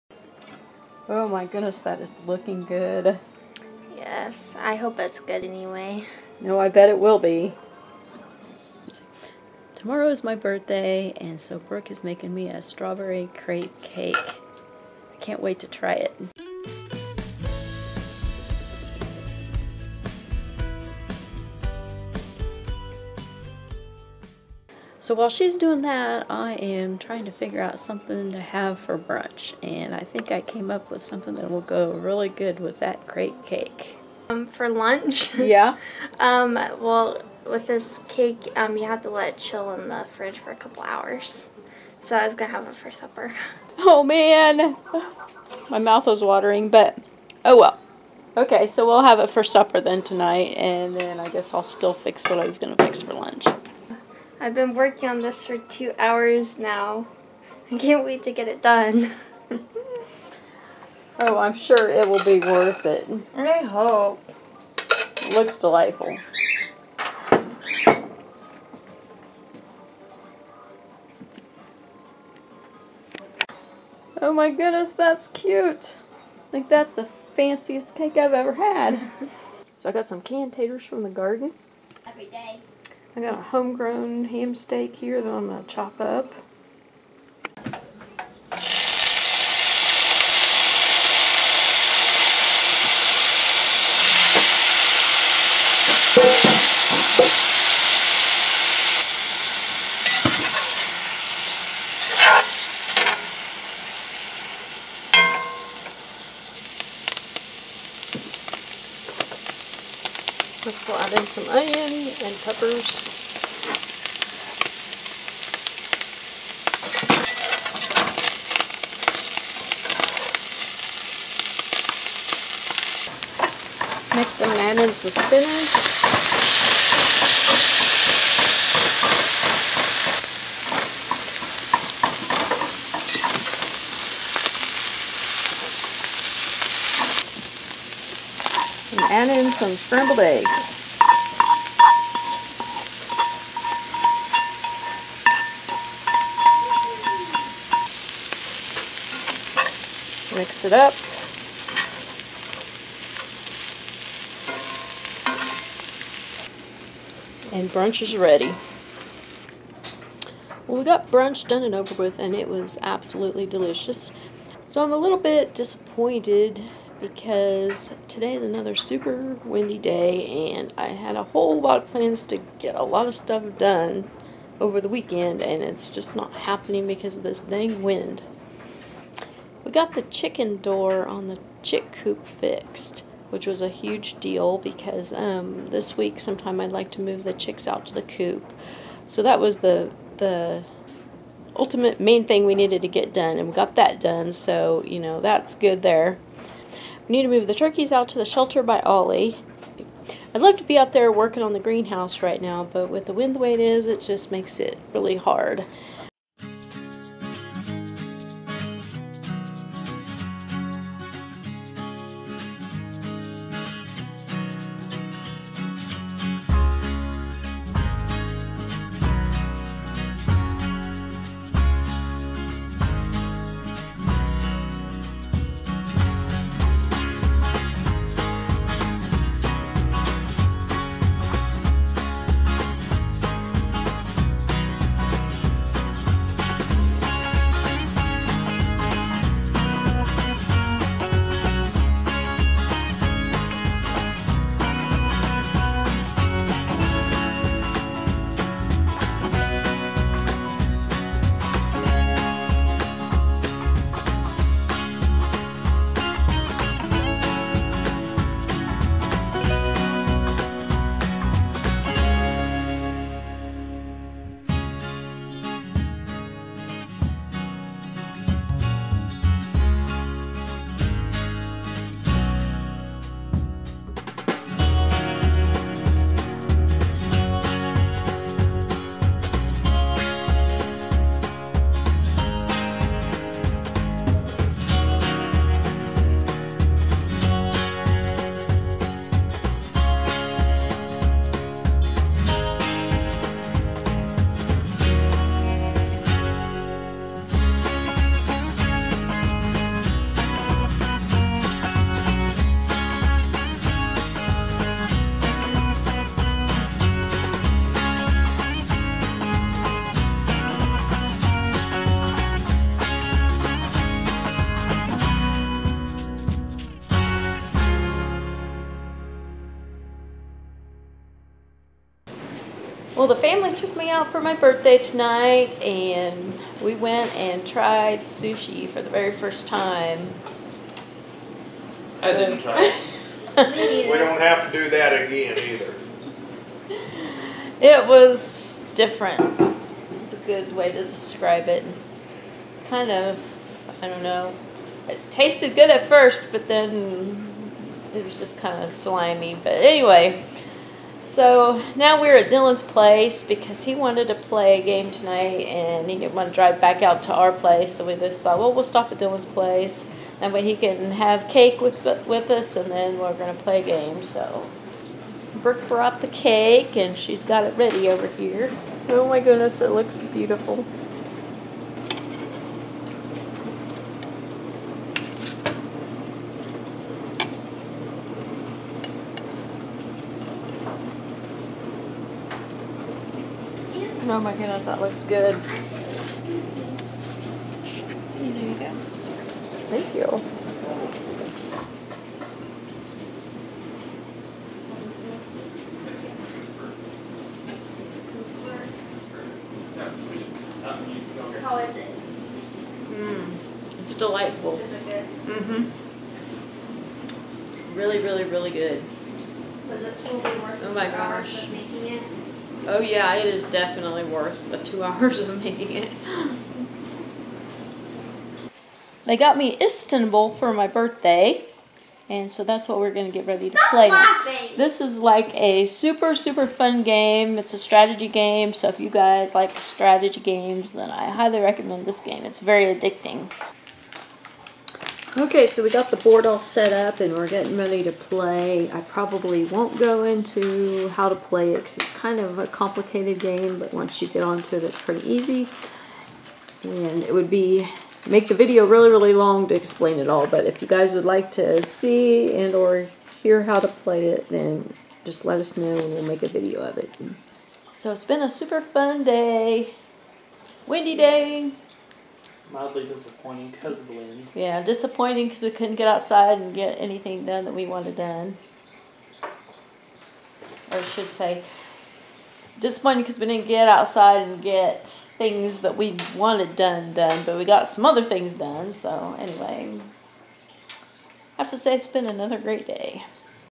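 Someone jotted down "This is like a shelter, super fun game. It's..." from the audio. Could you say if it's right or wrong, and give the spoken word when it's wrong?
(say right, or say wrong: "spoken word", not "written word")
wrong: "super", not "shelter".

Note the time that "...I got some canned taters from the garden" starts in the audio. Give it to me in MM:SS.
01:19.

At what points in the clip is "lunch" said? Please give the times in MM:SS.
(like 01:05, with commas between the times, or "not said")
00:34, 00:53.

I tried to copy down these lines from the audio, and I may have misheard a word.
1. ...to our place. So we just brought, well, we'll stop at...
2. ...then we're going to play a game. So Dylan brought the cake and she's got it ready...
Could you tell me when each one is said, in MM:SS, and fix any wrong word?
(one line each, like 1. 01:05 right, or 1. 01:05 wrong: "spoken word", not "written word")
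1. 05:57 wrong: "thought", not "brought"
2. 06:02 wrong: "Brooke", not "Dylan".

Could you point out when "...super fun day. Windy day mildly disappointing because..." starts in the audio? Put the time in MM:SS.
07:38.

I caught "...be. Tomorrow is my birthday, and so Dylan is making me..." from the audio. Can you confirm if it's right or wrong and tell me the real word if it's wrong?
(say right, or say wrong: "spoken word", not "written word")
wrong: "Brooke", not "Dylan".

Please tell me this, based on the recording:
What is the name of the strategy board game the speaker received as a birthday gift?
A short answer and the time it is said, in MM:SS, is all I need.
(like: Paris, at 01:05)
Istanbul, at 06:59.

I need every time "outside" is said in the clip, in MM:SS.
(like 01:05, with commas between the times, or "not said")
07:45, 07:53.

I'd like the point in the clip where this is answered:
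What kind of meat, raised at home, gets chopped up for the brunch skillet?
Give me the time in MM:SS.
01:24.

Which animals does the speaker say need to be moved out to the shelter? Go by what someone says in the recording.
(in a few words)
Turkeys.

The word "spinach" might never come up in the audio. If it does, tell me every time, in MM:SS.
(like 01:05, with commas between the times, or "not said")
02:05.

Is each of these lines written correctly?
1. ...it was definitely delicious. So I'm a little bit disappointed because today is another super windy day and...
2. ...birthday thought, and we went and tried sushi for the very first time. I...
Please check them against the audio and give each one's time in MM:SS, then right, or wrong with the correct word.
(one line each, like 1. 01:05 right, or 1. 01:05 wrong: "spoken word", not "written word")
1. 02:42 wrong: "absolutely", not "definitely"
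2. 05:24 wrong: "tonight", not "thought".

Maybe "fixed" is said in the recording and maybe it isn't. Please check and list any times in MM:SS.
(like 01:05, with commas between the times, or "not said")
03:02.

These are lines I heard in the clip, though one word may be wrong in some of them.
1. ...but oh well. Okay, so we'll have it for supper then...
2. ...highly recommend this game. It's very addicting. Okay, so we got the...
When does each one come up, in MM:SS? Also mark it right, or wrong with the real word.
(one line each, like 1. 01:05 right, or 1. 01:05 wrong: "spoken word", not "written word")
1. 00:46 right
2. 07:11 right.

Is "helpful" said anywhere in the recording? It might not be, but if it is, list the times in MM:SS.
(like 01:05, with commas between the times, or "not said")
not said.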